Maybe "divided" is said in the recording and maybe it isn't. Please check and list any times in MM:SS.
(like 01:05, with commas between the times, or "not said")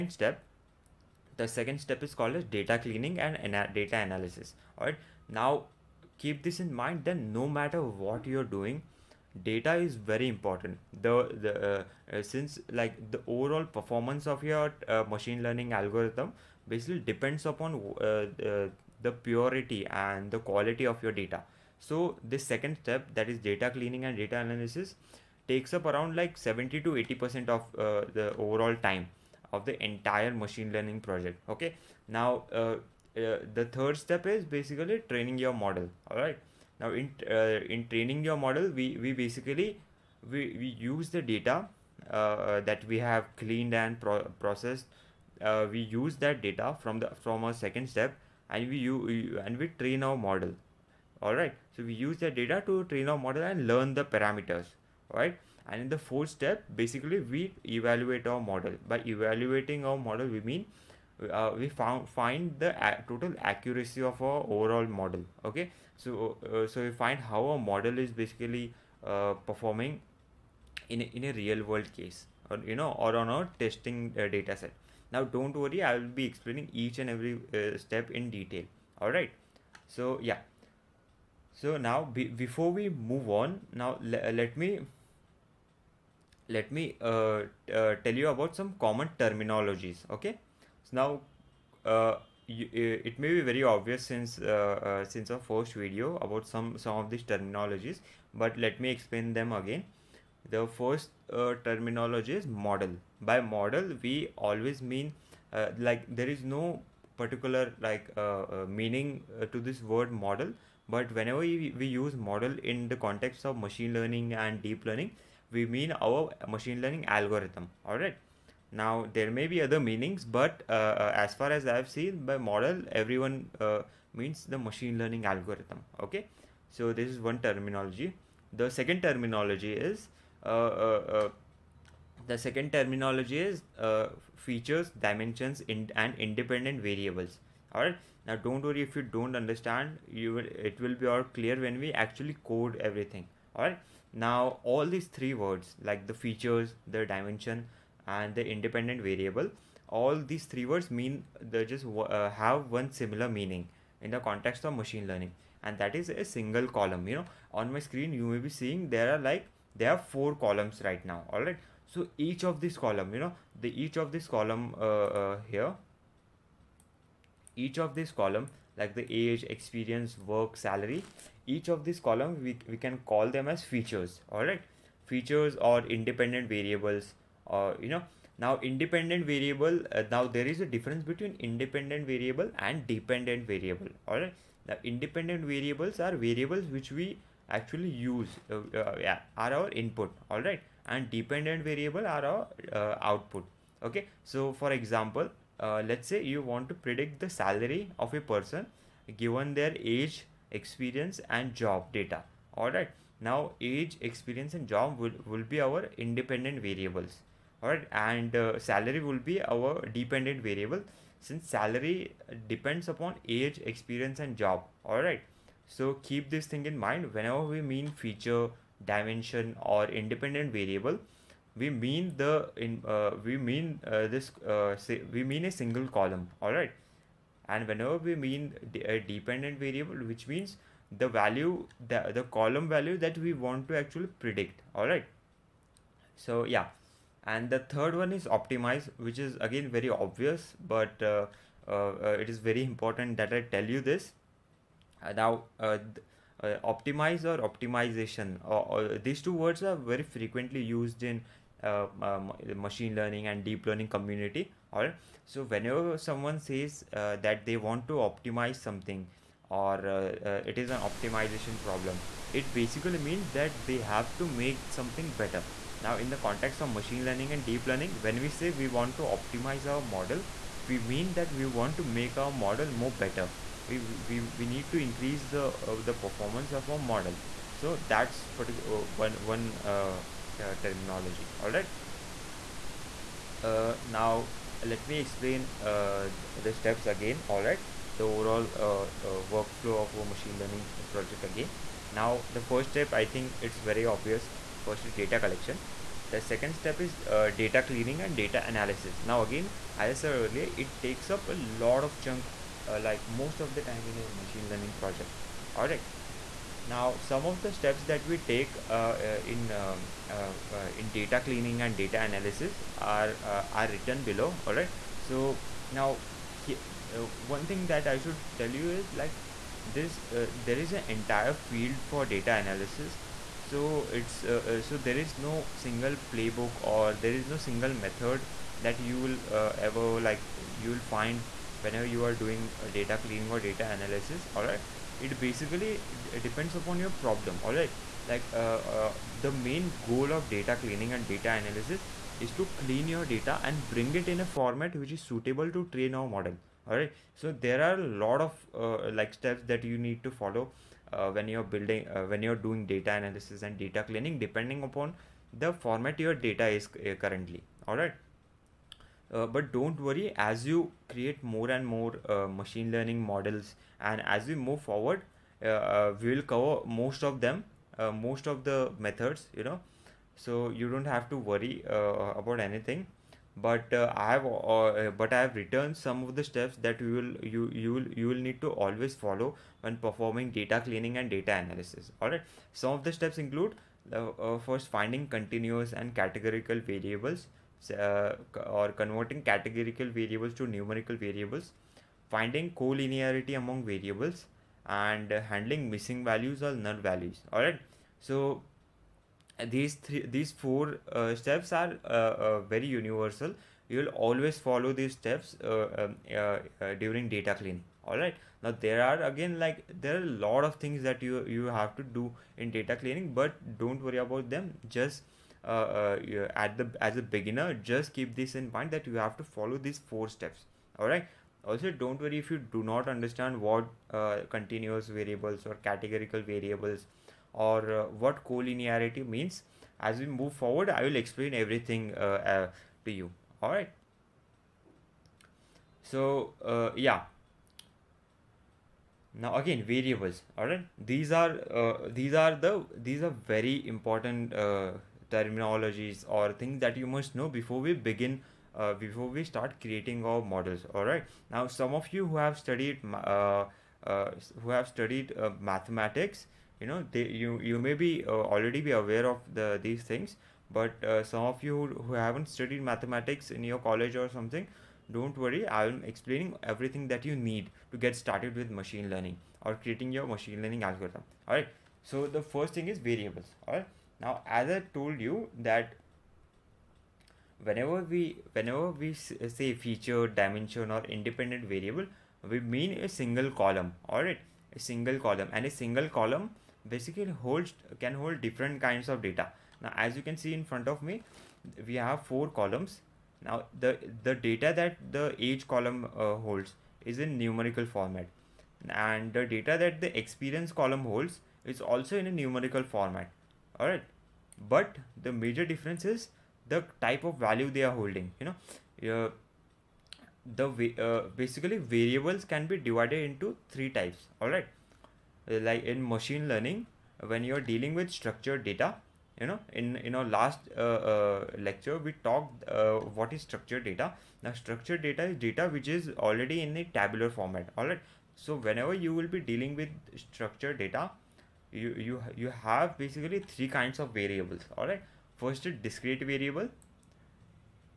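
08:32.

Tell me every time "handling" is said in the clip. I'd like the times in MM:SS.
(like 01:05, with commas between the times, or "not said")
06:35.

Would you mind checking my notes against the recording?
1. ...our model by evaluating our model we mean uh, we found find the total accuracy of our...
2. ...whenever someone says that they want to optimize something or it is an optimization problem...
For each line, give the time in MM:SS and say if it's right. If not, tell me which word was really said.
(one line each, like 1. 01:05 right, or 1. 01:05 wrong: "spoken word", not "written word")
1. 00:58 right
2. 04:15 right.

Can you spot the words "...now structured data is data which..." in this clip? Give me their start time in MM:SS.
08:44.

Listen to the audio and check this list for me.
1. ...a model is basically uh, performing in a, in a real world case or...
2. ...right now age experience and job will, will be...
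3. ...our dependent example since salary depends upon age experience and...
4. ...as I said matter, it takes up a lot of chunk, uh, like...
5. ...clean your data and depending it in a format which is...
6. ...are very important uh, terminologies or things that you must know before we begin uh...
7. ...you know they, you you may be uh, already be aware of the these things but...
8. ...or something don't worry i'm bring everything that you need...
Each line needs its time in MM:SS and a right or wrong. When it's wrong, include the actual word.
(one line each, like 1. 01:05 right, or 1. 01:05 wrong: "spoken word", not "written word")
1. 01:07 right
2. 03:22 right
3. 03:29 wrong: "variable", not "example"
4. 04:59 wrong: "earlier", not "matter"
5. 05:42 wrong: "bring", not "depending"
6. 07:23 right
7. 07:36 right
8. 07:44 wrong: "explaining", not "bring".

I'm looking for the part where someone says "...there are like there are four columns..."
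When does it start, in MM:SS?
02:38.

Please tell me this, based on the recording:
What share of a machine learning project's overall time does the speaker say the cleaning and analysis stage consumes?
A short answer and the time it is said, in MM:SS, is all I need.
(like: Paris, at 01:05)
70 to 80 percent, at 00:26.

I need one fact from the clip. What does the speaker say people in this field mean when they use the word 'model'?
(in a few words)
The machine learning algorithm.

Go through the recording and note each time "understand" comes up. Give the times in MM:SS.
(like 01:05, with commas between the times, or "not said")
02:19, 07:02.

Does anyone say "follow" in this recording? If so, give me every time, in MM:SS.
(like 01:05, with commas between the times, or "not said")
05:50, 06:18, 06:44, 06:59.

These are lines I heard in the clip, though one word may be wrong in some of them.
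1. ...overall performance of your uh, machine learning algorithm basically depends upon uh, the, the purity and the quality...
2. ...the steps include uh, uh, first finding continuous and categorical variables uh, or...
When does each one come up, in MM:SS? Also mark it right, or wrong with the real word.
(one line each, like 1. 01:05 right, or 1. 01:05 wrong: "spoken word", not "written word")
1. 00:13 right
2. 06:22 right.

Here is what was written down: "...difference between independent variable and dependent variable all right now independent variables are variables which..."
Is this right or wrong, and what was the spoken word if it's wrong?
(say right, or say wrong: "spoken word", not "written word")
right.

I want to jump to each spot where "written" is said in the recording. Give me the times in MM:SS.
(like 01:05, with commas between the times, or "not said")
05:13, 06:15.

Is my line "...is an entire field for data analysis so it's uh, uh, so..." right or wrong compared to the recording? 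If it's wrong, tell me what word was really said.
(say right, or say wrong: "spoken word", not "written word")
right.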